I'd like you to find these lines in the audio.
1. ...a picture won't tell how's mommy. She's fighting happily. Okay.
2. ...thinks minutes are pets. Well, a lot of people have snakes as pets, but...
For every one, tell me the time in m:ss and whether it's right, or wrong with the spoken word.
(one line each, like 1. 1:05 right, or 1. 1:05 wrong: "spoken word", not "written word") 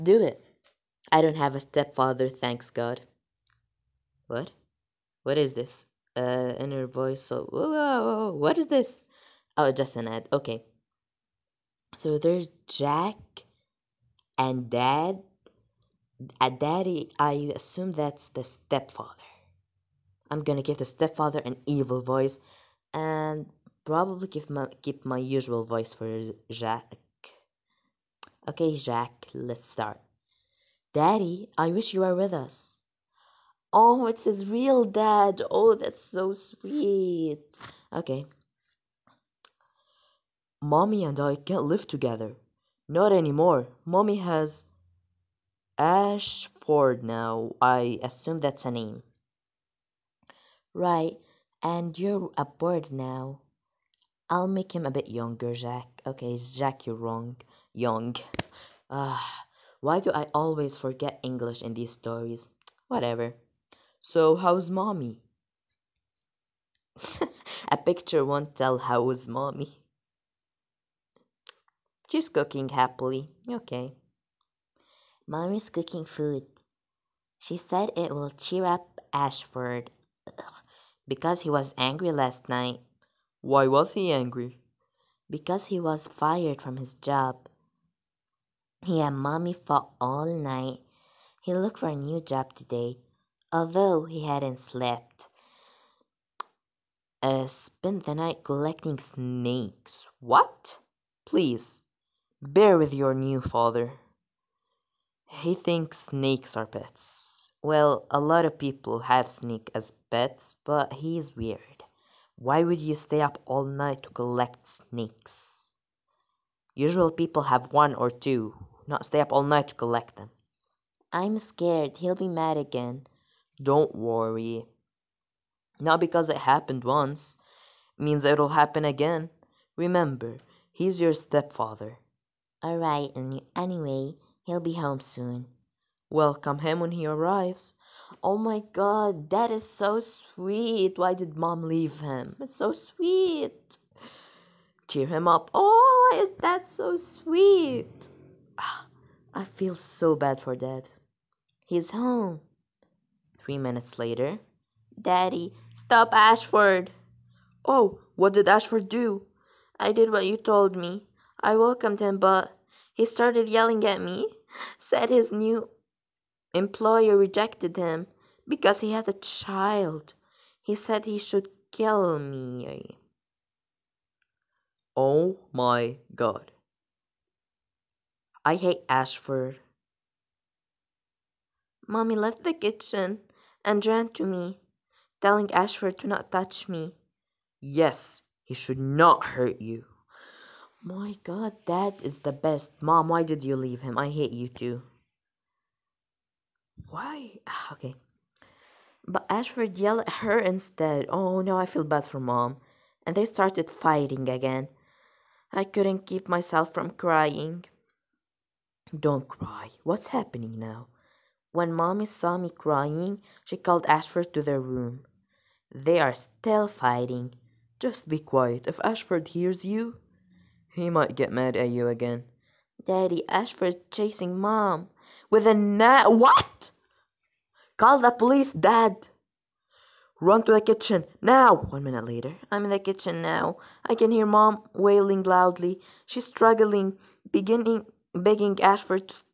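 1. 1:07 wrong: "cooking", not "fighting"
2. 1:45 wrong: "snakes", not "minutes".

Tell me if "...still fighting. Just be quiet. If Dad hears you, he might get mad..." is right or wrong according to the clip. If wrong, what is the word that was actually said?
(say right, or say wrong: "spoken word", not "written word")
wrong: "Ashford", not "Dad".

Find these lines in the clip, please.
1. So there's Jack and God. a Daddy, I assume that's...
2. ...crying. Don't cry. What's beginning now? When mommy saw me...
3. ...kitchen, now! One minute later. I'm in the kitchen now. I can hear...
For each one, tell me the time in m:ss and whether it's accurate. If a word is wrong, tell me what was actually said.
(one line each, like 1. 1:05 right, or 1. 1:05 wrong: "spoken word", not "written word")
1. 0:11 wrong: "Dad", not "God"
2. 3:26 wrong: "happening", not "beginning"
3. 3:50 right.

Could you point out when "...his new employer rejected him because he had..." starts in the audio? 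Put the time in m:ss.
2:45.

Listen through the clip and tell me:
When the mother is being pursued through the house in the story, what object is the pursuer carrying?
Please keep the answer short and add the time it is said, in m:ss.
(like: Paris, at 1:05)
A net, at 3:45.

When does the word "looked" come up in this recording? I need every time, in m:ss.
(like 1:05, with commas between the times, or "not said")
1:31.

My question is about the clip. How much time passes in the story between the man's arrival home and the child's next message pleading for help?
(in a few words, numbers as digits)
3 minutes.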